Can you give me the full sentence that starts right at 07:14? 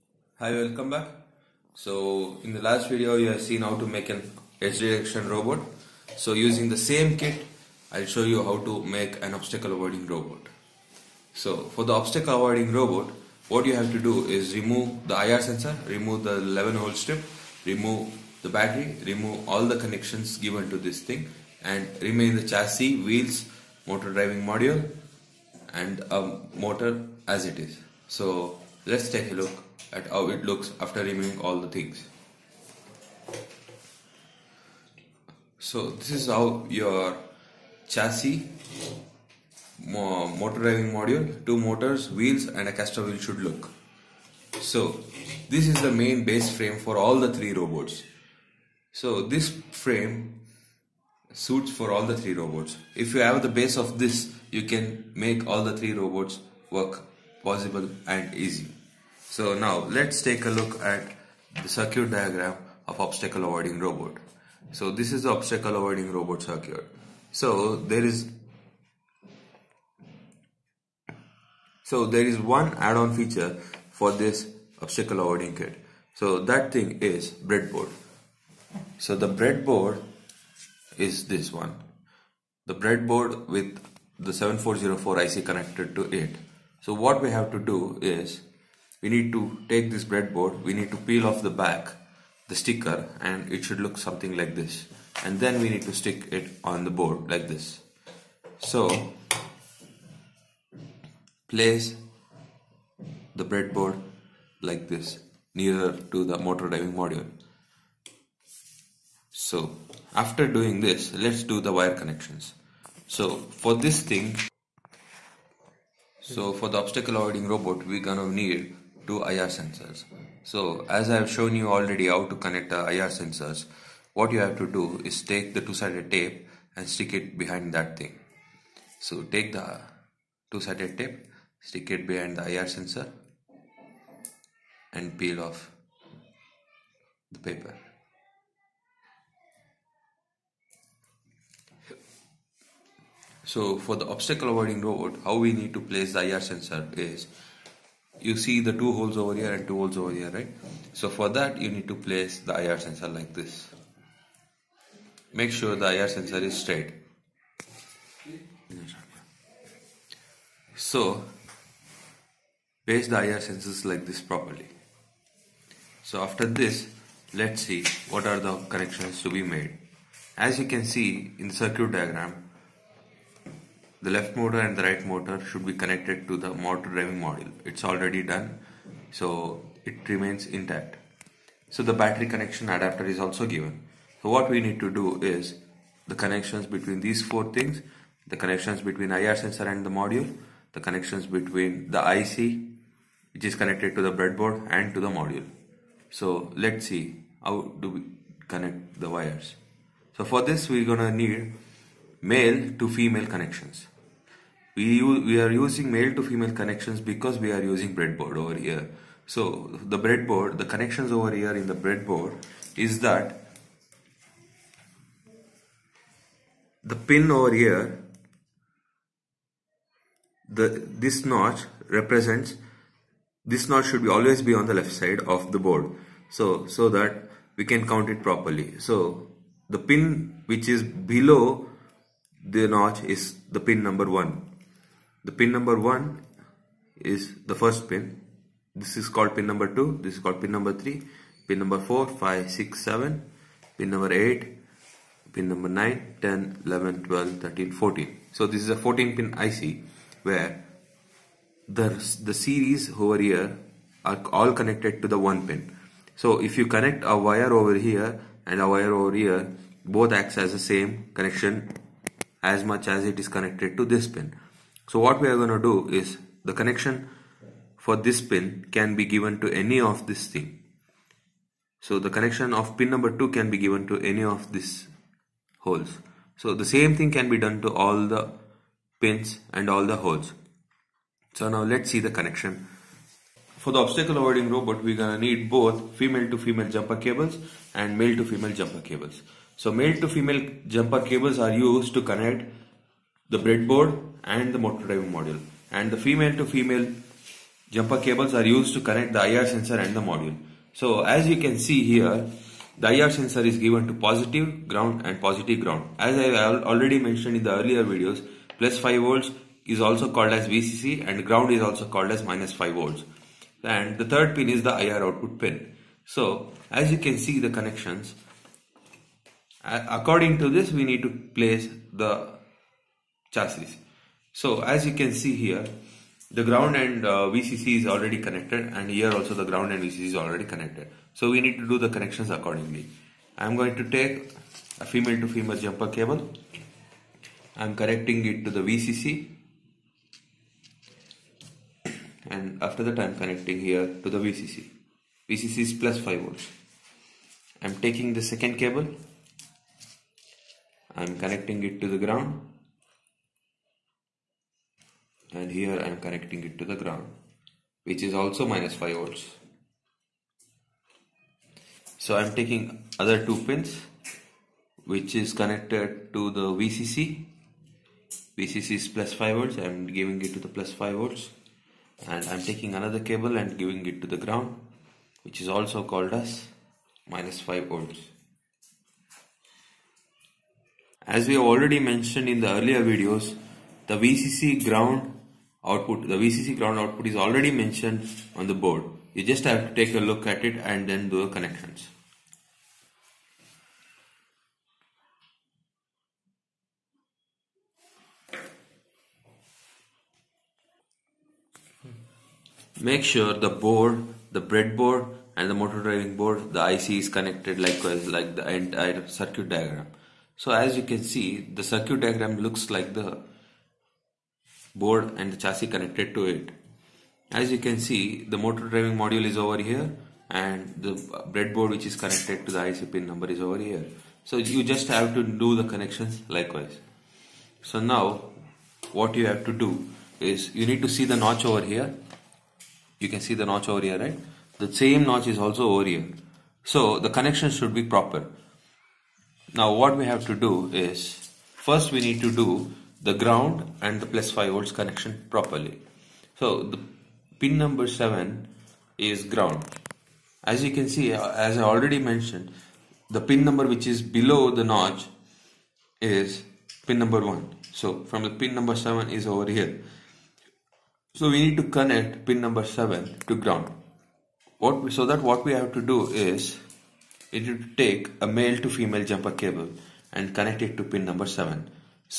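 The same notch is also over here.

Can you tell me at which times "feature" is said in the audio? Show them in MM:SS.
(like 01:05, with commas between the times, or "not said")
01:13.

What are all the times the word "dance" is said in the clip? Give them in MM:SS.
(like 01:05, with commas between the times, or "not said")
not said.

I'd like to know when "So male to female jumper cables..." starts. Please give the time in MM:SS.
04:49.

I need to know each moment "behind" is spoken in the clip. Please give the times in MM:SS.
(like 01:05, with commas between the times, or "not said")
02:07, 02:12.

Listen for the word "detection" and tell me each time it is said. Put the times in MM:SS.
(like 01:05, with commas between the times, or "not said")
00:04.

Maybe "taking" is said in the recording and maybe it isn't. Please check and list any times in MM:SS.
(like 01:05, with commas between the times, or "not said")
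05:47, 06:02, 06:12.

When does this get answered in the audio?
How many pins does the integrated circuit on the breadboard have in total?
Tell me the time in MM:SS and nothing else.
04:08.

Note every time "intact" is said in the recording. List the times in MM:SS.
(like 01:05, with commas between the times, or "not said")
03:00.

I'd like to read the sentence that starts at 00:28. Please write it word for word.
So Let's take a look at how it looks after removing all the things.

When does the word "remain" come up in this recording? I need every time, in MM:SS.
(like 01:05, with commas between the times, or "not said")
00:22, 03:00.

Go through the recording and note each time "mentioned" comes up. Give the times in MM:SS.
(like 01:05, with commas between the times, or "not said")
05:06, 06:21, 06:27, 07:31.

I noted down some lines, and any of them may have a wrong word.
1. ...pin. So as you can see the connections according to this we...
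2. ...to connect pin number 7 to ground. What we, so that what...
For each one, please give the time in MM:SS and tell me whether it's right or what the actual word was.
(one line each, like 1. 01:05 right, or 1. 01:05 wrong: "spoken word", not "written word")
1. 05:15 right
2. 07:41 right.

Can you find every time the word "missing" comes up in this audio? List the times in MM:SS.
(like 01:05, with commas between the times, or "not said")
not said.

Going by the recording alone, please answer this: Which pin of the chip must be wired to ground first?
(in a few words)
7.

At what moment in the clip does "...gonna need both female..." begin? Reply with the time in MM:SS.
04:44.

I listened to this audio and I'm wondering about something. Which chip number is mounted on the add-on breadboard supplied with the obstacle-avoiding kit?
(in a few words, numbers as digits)
7404.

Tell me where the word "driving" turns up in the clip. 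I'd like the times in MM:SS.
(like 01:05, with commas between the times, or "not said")
00:24, 00:40, 01:46, 02:56, 04:54, 06:45, 06:58.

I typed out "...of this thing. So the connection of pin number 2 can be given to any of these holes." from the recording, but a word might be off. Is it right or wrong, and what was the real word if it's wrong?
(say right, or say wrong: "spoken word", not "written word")
right.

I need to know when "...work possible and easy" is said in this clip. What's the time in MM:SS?
00:56.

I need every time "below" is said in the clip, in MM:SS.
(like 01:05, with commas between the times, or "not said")
03:50, 07:34.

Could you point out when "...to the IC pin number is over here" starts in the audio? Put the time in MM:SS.
07:02.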